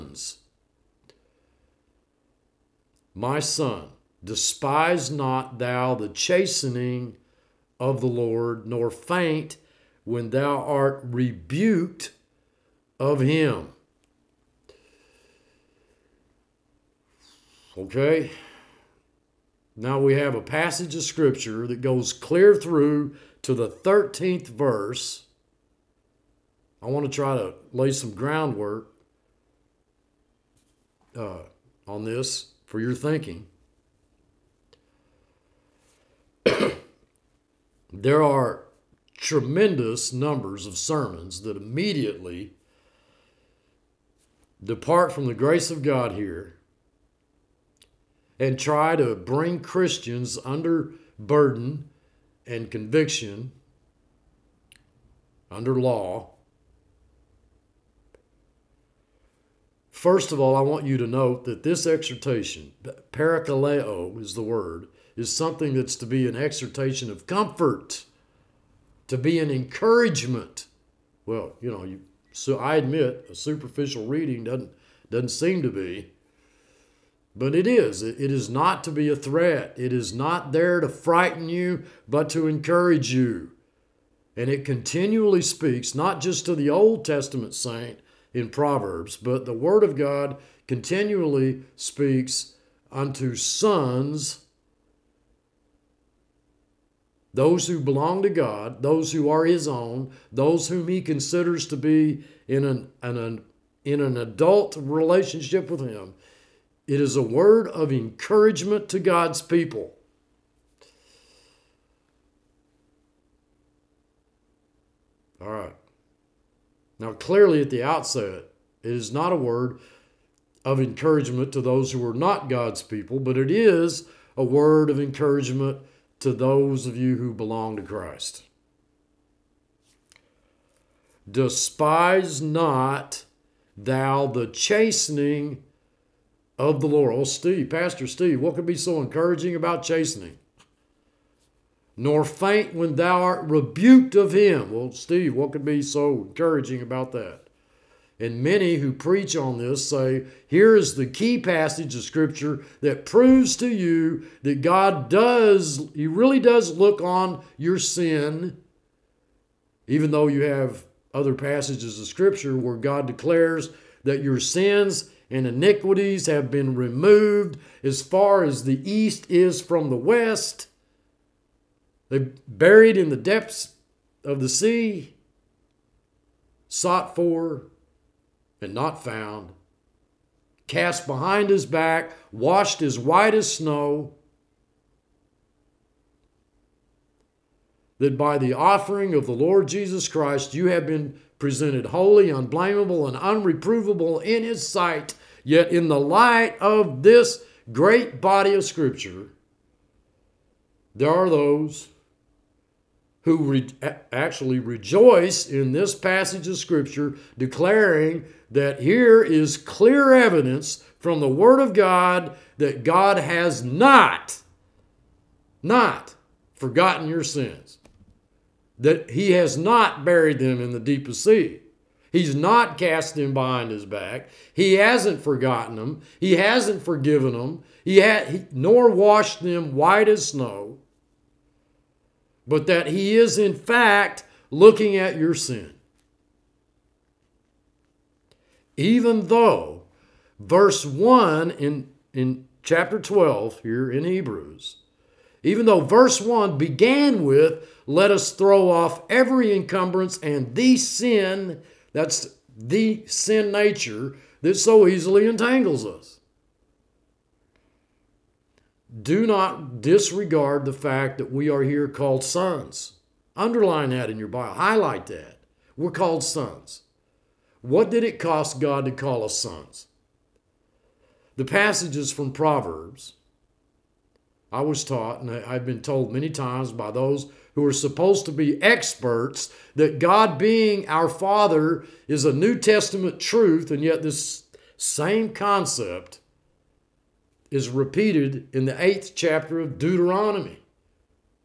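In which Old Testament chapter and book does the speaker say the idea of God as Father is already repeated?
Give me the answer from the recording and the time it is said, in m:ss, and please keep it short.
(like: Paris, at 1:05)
Deuteronomy chapter 8, at 4:48.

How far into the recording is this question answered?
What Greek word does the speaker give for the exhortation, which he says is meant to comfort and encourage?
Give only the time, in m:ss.
1:03.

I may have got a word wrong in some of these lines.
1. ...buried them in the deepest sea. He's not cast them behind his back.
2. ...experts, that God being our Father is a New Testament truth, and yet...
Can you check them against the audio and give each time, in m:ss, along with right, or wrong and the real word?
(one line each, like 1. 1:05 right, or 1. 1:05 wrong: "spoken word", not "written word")
1. 3:40 right
2. 4:38 right.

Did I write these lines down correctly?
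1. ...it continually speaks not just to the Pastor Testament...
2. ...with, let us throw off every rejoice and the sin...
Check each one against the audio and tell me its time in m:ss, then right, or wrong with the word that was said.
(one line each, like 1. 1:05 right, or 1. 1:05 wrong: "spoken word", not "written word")
1. 1:24 wrong: "Old", not "Pastor"
2. 4:07 wrong: "encumbrance", not "rejoice".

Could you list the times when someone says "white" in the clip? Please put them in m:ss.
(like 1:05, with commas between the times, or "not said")
3:02, 3:49.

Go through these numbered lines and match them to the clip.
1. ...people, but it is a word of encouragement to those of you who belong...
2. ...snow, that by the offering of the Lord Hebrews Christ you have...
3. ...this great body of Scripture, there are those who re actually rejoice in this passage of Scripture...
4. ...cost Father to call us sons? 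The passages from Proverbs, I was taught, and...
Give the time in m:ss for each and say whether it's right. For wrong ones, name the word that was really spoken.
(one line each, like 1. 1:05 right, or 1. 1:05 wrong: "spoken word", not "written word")
1. 2:02 right
2. 3:03 wrong: "Jesus", not "Hebrews"
3. 3:17 right
4. 4:28 wrong: "God", not "Father".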